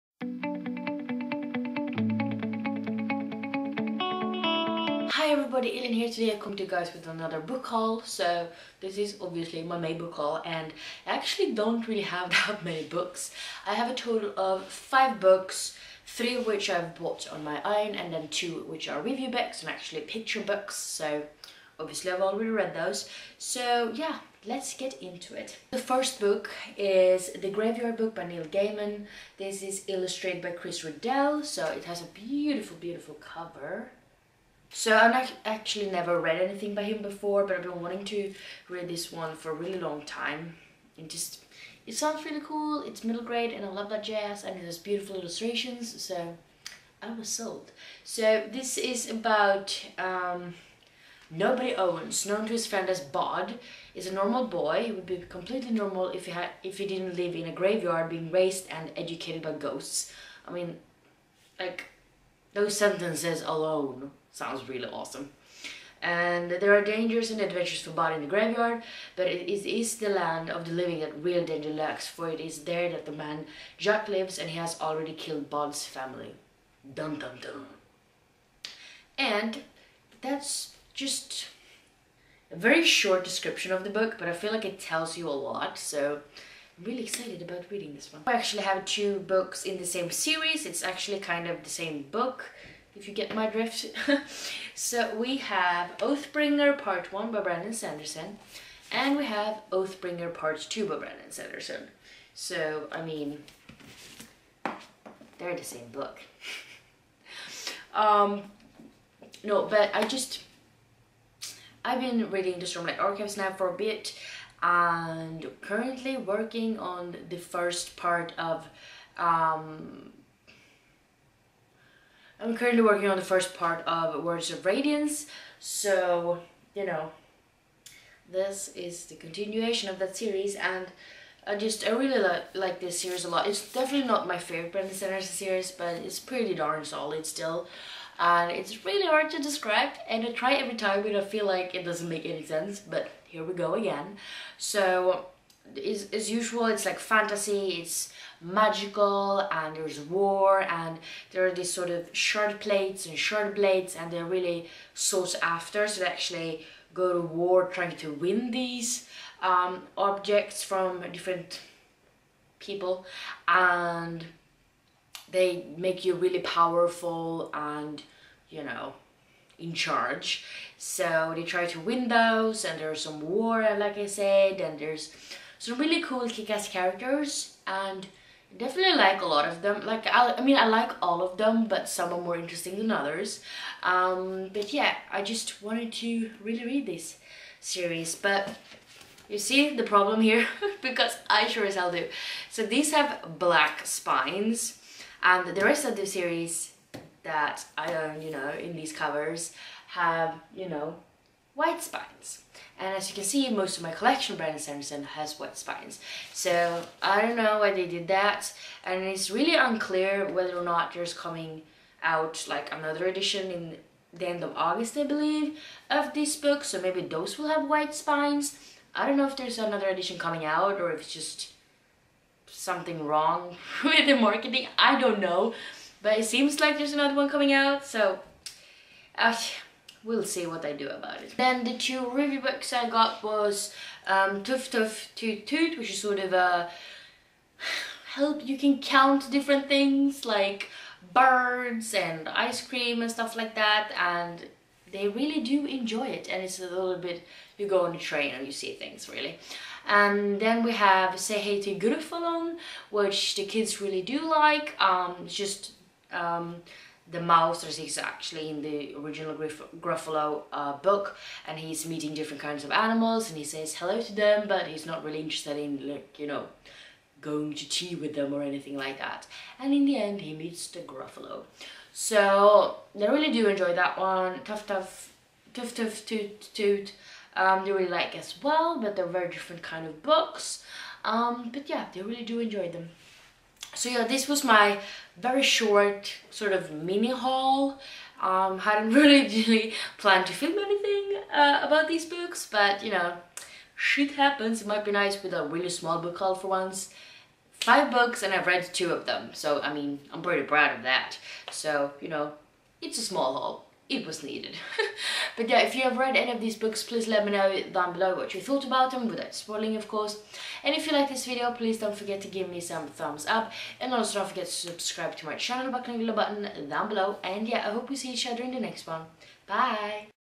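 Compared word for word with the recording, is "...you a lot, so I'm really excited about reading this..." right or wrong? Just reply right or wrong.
right.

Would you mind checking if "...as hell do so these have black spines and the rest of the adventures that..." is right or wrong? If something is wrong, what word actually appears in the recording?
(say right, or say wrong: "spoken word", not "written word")
wrong: "series", not "adventures".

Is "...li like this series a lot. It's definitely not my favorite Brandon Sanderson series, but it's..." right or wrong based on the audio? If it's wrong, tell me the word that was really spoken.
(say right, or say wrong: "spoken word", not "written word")
right.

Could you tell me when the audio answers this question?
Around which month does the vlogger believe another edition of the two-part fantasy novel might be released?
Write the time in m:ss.
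3:34.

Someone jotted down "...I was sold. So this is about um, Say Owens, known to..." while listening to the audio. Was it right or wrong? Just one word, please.
wrong.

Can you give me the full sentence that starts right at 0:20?
So obviously I've already read those.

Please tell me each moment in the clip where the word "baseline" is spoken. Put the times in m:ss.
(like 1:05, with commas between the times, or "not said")
not said.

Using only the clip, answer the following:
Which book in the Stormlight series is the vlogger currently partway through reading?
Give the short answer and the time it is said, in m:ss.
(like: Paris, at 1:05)
Words of Radiance, at 2:04.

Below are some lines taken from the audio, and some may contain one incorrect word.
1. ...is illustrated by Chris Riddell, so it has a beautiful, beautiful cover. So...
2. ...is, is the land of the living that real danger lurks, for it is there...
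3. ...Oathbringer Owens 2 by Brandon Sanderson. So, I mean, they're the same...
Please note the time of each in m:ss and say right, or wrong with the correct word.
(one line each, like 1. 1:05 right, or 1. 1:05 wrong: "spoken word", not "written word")
1. 0:29 right
2. 1:09 right
3. 1:39 wrong: "Part", not "Owens".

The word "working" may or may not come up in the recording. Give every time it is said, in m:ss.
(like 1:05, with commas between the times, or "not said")
1:56, 2:02.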